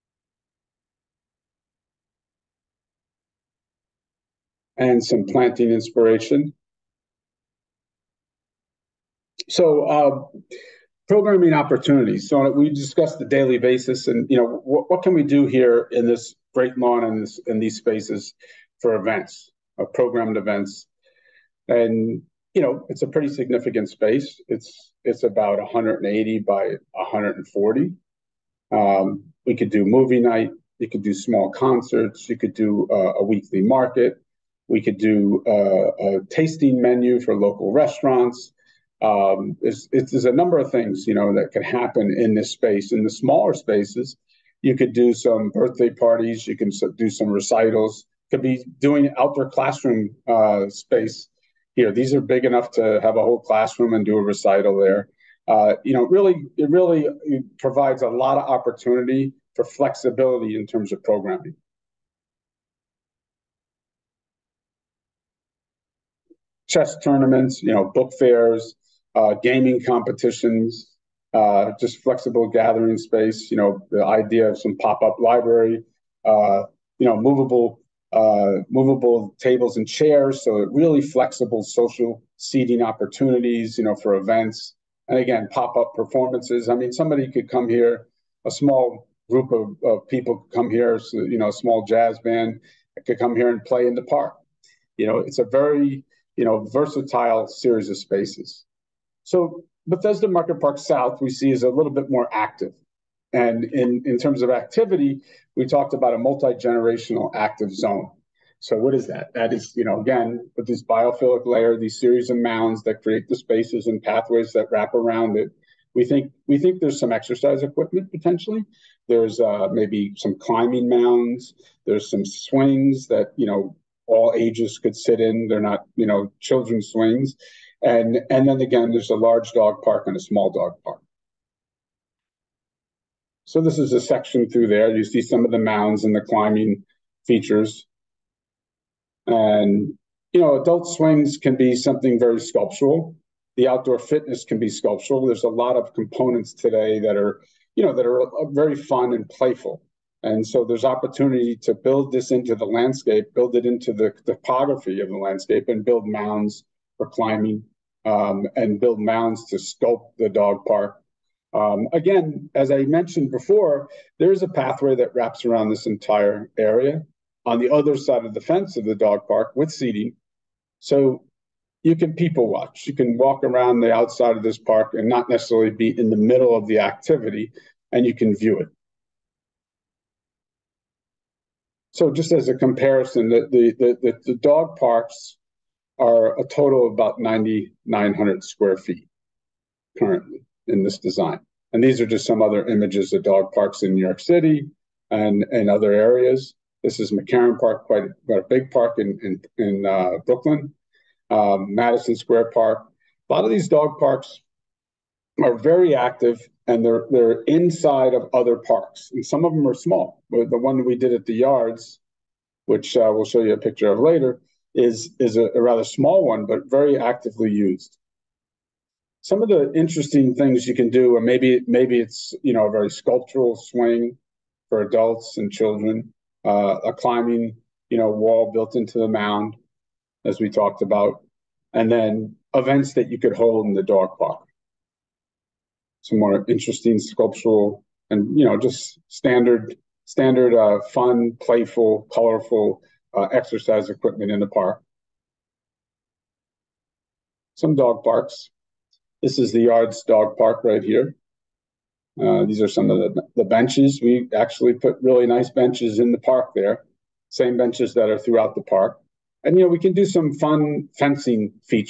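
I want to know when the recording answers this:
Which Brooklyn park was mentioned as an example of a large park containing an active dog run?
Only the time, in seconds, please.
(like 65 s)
197 s.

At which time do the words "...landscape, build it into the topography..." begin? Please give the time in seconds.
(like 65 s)
152 s.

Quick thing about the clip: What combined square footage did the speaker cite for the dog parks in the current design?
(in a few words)
9,900 square feet.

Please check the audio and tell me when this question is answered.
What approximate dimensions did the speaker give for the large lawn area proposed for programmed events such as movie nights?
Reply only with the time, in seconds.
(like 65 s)
25 s.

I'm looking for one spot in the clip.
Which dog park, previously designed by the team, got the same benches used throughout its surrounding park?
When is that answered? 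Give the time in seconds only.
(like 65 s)
249 s.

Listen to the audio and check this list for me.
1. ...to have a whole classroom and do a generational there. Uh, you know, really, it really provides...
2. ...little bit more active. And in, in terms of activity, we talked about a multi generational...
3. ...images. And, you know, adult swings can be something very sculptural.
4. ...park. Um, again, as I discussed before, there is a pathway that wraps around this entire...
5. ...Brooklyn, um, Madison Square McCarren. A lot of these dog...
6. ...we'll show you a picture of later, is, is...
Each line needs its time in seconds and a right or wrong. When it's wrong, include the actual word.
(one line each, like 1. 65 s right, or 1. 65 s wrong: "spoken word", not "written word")
1. 52 s wrong: "recital", not "generational"
2. 101 s right
3. 137 s wrong: "features", not "images"
4. 160 s wrong: "mentioned", not "discussed"
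5. 200 s wrong: "Park", not "McCarren"
6. 213 s right.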